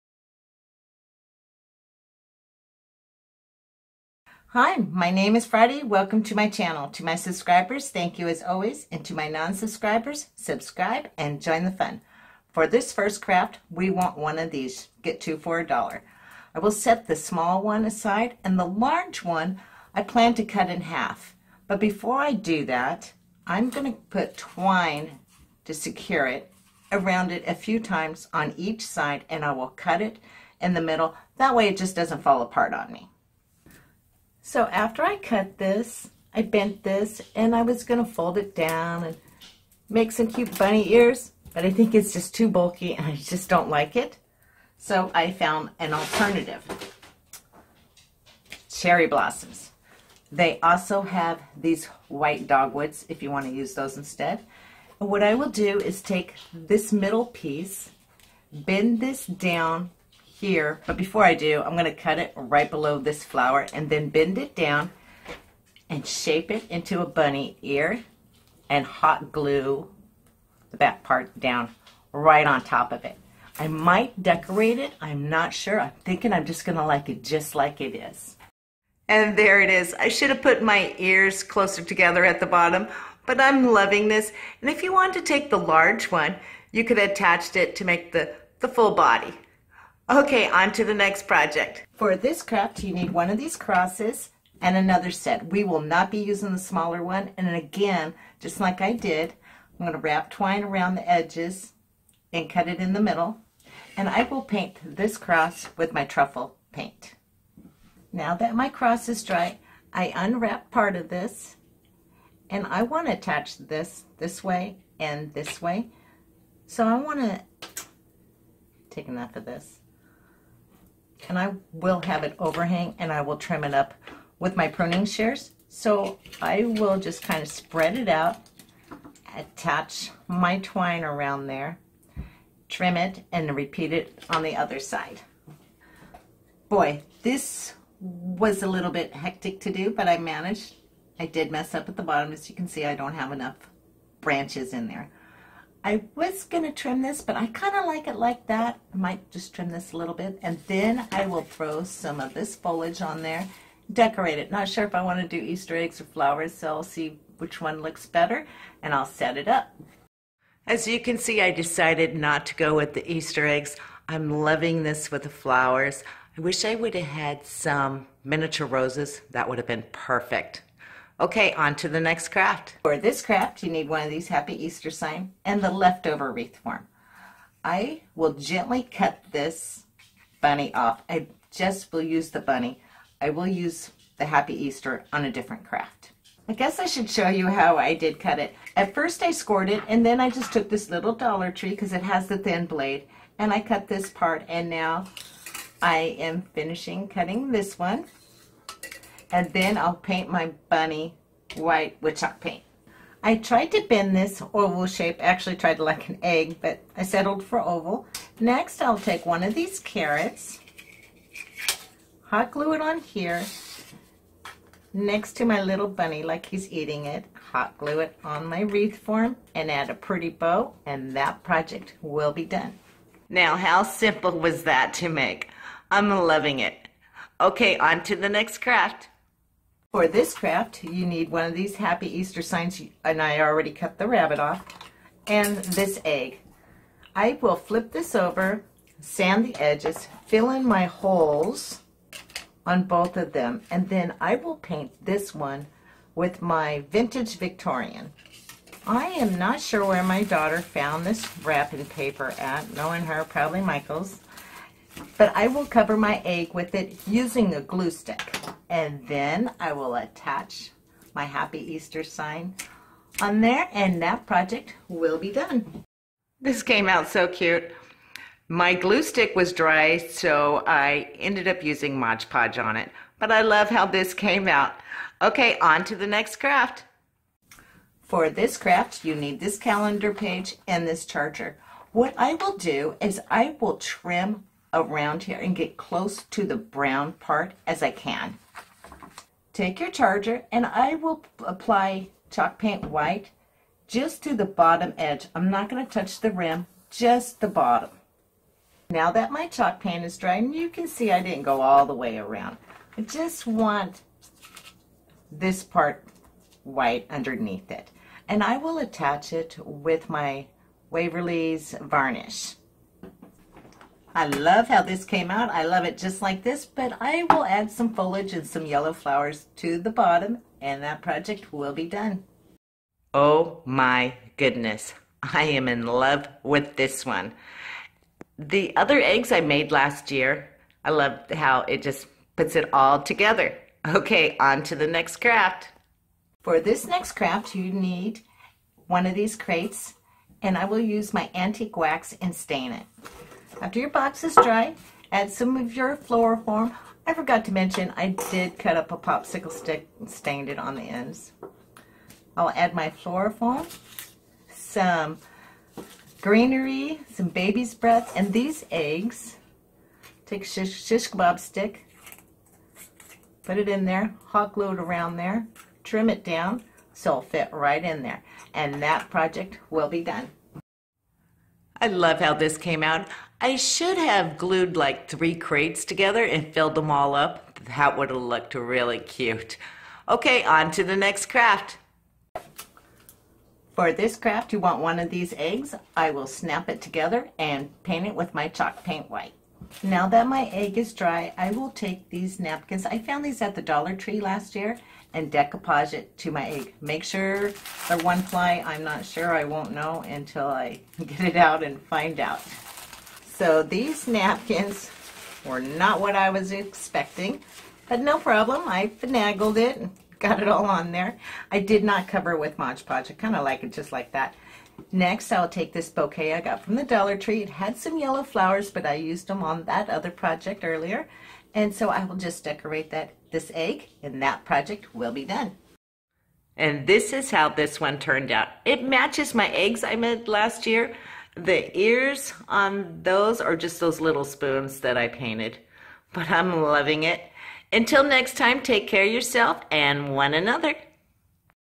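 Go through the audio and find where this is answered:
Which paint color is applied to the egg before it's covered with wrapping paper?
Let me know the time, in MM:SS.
04:06.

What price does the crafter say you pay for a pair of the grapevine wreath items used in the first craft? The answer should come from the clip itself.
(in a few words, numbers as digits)
Two for a dollar.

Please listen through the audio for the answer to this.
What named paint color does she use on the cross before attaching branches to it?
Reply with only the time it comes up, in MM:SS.
01:46.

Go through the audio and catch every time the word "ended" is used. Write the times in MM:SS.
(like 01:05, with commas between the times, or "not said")
04:31.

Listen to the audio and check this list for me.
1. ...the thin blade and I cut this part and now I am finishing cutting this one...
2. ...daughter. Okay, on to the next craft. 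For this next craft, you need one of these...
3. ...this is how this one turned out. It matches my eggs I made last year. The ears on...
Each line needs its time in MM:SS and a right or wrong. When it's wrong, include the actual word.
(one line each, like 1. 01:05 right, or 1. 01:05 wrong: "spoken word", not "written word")
1. 03:12 right
2. 05:33 wrong: "together", not "daughter"
3. 07:06 right.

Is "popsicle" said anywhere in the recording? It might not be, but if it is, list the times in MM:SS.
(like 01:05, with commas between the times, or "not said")
05:48.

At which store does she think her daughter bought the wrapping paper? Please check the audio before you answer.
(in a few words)
Michael's.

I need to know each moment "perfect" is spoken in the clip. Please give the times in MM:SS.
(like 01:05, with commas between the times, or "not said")
02:49.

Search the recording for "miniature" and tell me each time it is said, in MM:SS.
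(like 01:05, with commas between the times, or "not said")
02:48.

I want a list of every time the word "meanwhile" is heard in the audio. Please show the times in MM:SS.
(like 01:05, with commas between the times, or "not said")
not said.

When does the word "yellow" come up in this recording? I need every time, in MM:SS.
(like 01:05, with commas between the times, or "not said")
05:18, 06:57.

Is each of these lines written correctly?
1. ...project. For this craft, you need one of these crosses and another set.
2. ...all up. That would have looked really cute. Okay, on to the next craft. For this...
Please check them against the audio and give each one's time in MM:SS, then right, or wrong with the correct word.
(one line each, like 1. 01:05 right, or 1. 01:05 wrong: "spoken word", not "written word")
1. 01:31 right
2. 06:16 right.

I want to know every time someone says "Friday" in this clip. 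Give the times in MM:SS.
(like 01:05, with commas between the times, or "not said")
00:05.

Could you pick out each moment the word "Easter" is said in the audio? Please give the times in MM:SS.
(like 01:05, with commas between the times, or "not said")
02:35, 02:43, 02:54, 03:04, 03:52, 04:21.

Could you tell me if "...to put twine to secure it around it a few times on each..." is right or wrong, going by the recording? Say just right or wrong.
right.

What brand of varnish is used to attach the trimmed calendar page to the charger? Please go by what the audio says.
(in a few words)
Waverly.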